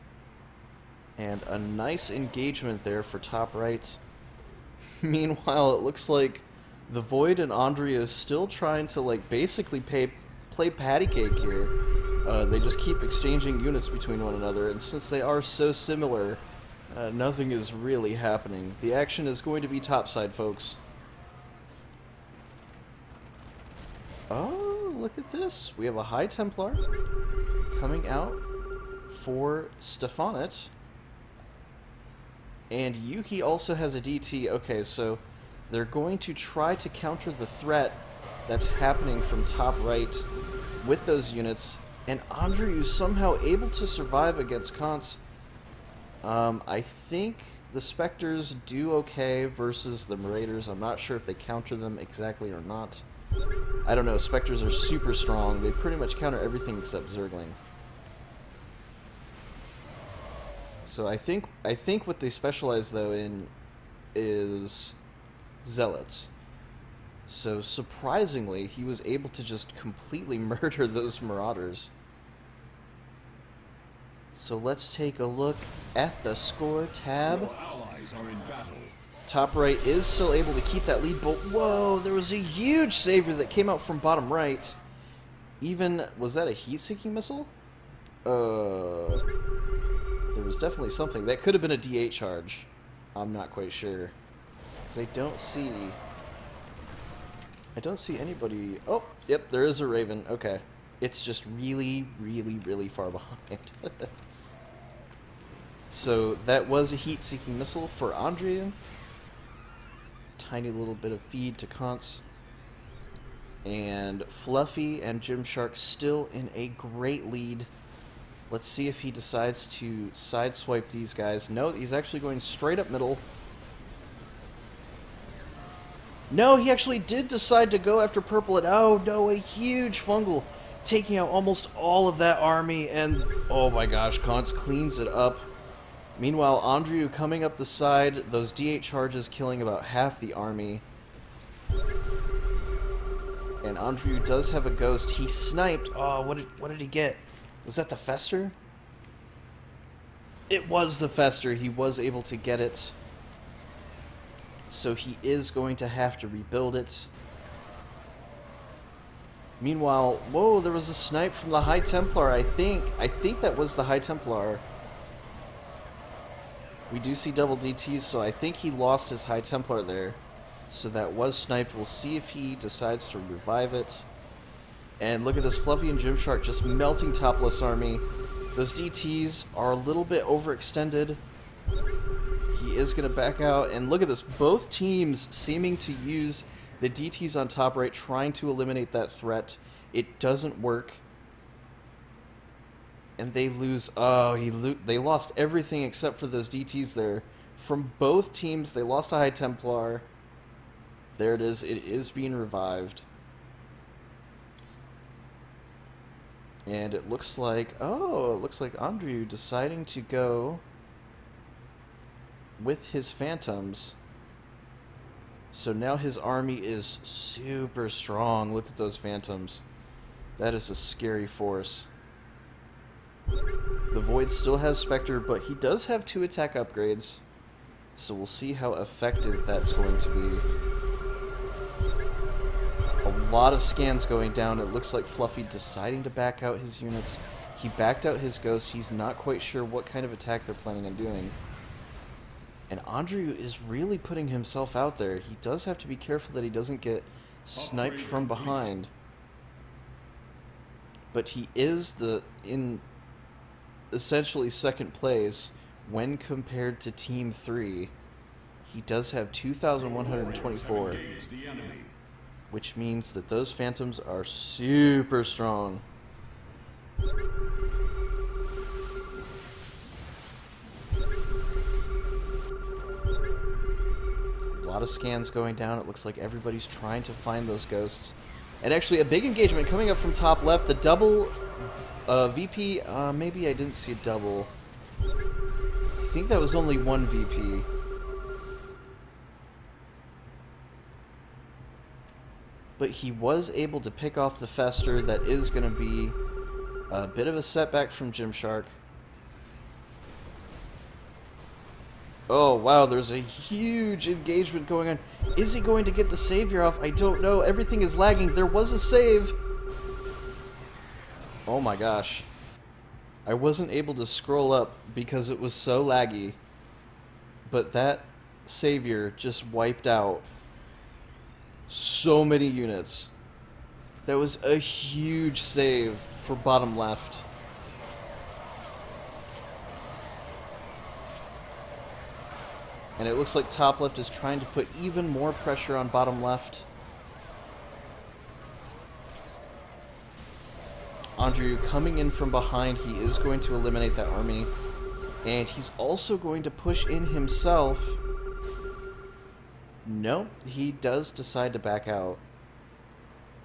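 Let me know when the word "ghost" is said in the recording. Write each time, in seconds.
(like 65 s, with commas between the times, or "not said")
144 s, 238 s, 277 s.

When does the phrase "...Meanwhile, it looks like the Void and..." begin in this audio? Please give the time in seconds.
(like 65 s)
5 s.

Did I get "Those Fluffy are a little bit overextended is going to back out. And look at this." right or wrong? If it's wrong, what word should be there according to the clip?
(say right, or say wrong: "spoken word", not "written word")
wrong: "DTs", not "Fluffy".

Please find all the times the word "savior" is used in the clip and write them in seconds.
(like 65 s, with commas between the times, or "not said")
82 s, 306 s, 318 s.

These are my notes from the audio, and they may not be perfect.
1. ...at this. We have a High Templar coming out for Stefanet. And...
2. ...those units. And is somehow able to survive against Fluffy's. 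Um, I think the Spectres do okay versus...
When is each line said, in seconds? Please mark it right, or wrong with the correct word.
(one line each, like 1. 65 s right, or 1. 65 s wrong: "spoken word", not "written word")
1. 25 s right
2. 41 s wrong: "Kant", not "Fluffy".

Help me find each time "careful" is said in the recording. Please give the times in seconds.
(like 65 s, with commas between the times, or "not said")
245 s.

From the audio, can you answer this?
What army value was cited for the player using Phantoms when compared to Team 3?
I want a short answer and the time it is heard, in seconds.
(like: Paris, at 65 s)
2,124, at 259 s.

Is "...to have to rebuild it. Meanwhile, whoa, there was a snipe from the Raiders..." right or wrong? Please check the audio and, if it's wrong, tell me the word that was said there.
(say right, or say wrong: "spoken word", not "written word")
wrong: "High", not "Raiders".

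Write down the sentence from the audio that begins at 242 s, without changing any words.
And Andrew is really putting himself out there.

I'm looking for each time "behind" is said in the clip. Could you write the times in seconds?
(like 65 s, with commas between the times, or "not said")
103 s, 248 s, 342 s.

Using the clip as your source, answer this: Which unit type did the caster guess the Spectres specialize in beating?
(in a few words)
Zealots.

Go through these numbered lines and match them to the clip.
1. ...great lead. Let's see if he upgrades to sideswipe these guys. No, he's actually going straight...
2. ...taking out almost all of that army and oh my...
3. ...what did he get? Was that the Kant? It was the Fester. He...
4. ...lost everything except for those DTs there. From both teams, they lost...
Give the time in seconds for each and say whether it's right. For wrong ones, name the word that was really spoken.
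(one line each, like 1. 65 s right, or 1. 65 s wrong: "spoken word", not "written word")
1. 116 s wrong: "decides", not "upgrades"
2. 130 s right
3. 146 s wrong: "Fester", not "Kant"
4. 194 s right.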